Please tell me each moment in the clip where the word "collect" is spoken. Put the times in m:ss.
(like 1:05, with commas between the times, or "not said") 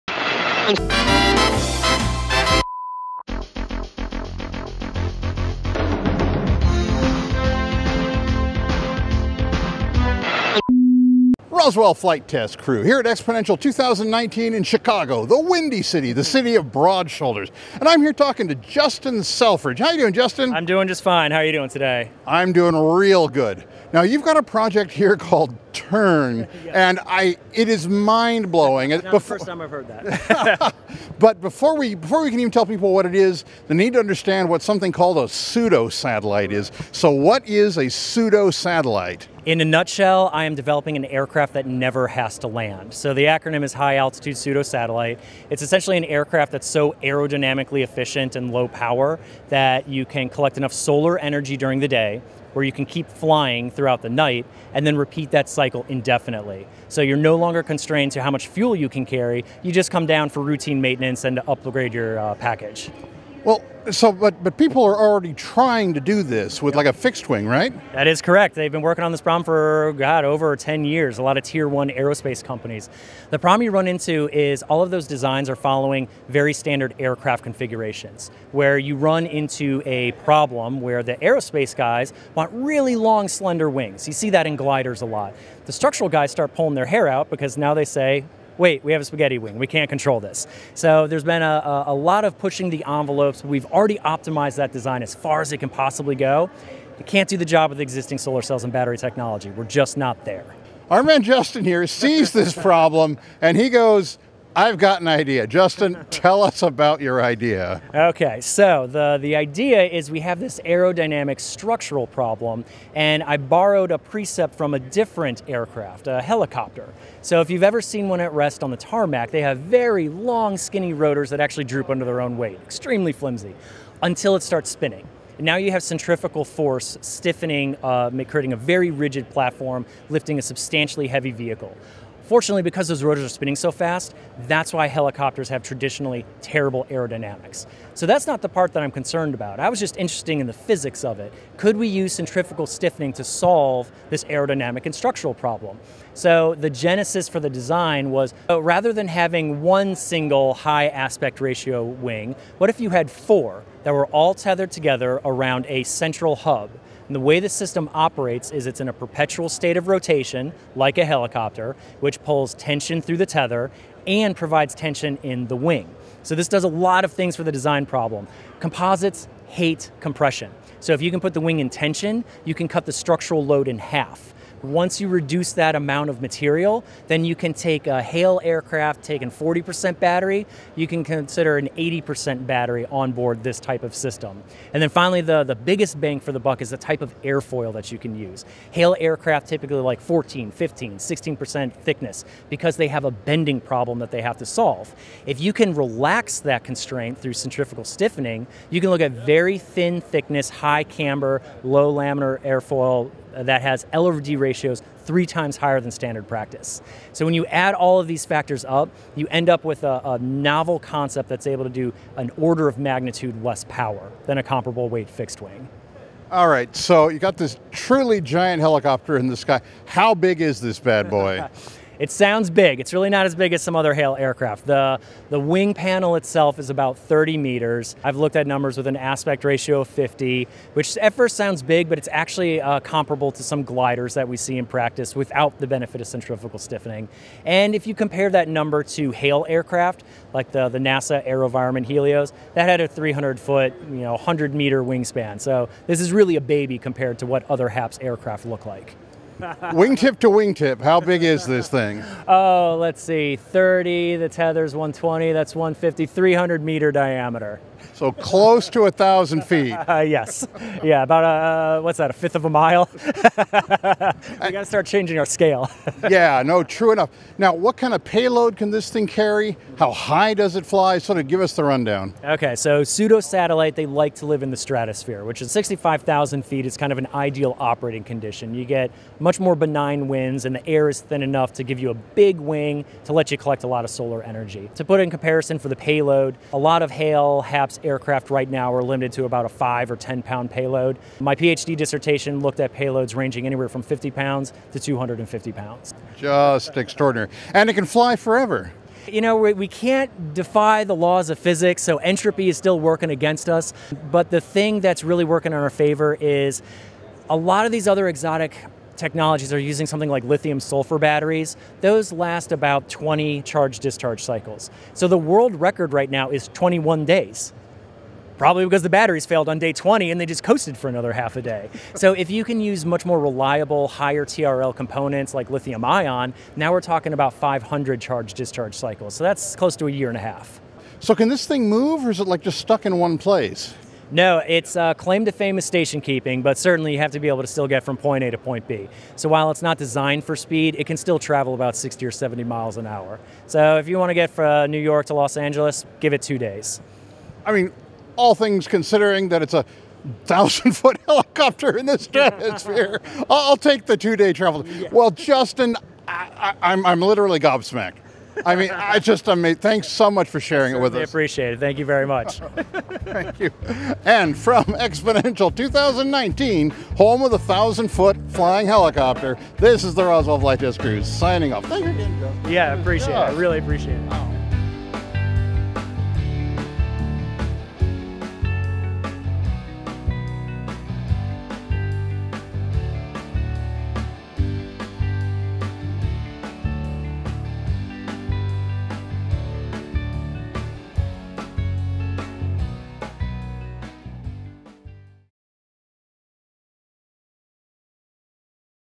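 0:50, 4:43.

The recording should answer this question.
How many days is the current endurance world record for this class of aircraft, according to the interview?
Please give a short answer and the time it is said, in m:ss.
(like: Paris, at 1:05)
21 days, at 5:16.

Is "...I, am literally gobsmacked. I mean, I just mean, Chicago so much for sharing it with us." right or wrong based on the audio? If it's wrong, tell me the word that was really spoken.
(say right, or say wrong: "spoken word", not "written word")
wrong: "Thanks", not "Chicago".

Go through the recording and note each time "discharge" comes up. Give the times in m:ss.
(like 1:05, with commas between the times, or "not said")
5:13, 5:28.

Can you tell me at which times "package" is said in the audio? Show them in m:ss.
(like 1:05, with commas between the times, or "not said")
1:02.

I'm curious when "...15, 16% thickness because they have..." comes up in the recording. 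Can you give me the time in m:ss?
3:10.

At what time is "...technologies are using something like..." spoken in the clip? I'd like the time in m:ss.
5:09.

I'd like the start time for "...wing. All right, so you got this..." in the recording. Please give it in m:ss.
3:35.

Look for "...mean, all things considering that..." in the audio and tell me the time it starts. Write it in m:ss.
5:47.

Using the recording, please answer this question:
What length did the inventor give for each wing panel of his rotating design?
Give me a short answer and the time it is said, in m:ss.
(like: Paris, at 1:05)
30 meters, at 3:46.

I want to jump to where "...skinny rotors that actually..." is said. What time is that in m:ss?
2:00.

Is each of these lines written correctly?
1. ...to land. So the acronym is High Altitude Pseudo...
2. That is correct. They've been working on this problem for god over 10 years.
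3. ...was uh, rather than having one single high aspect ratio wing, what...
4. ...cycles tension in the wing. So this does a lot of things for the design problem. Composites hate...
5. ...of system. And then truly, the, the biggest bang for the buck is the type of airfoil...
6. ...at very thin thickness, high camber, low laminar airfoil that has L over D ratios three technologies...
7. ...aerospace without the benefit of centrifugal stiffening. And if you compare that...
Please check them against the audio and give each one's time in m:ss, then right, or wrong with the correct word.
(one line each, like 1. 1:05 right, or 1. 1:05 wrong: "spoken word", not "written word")
1. 0:42 right
2. 1:07 right
3. 2:28 right
4. 2:44 wrong: "provides", not "cycles"
5. 3:03 wrong: "finally", not "truly"
6. 3:19 wrong: "times", not "technologies"
7. 3:54 wrong: "practice", not "aerospace".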